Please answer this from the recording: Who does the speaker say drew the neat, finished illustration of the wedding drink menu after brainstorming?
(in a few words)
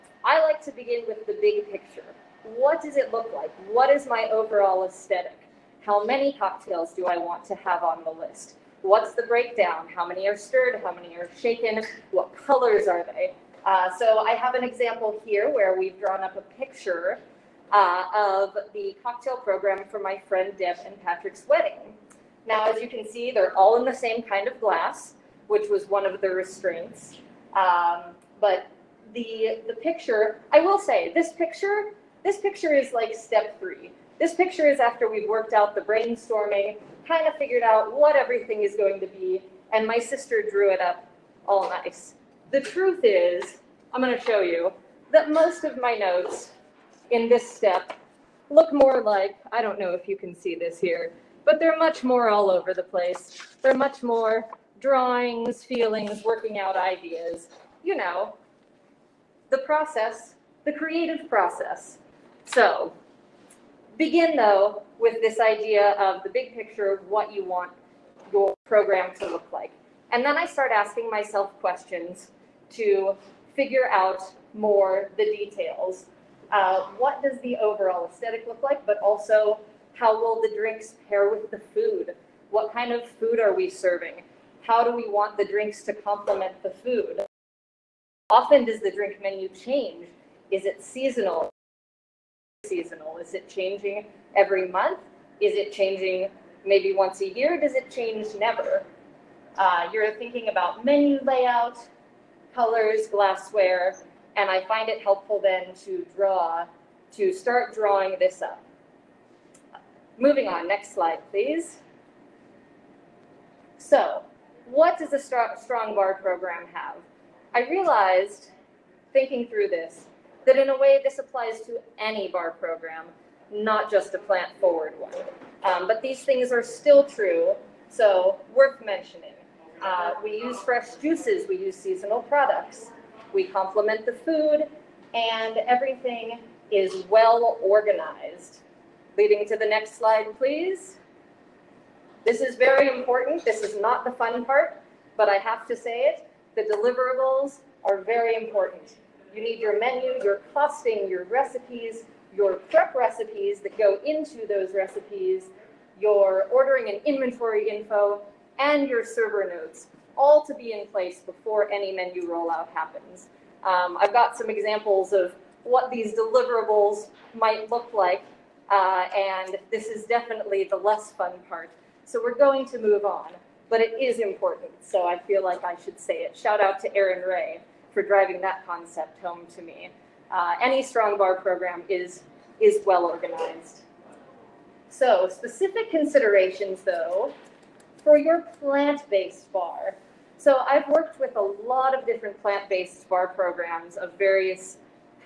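My sister.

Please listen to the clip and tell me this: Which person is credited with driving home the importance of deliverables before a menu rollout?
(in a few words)
Aaron Ray.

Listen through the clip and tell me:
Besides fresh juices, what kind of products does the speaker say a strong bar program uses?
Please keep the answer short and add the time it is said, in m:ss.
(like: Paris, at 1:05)
Seasonal products, at 2:11.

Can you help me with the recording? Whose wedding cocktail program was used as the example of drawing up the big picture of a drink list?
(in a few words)
Deb and Patrick.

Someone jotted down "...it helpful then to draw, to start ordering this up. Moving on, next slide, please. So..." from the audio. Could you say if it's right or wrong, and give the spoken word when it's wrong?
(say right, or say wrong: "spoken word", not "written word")
wrong: "drawing", not "ordering".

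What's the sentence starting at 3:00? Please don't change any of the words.
Uh, any strong bar program is, is well organized.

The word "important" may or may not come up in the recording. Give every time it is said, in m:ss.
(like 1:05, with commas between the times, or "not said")
2:22, 2:28, 2:54.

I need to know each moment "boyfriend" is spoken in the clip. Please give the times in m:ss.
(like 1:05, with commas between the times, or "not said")
not said.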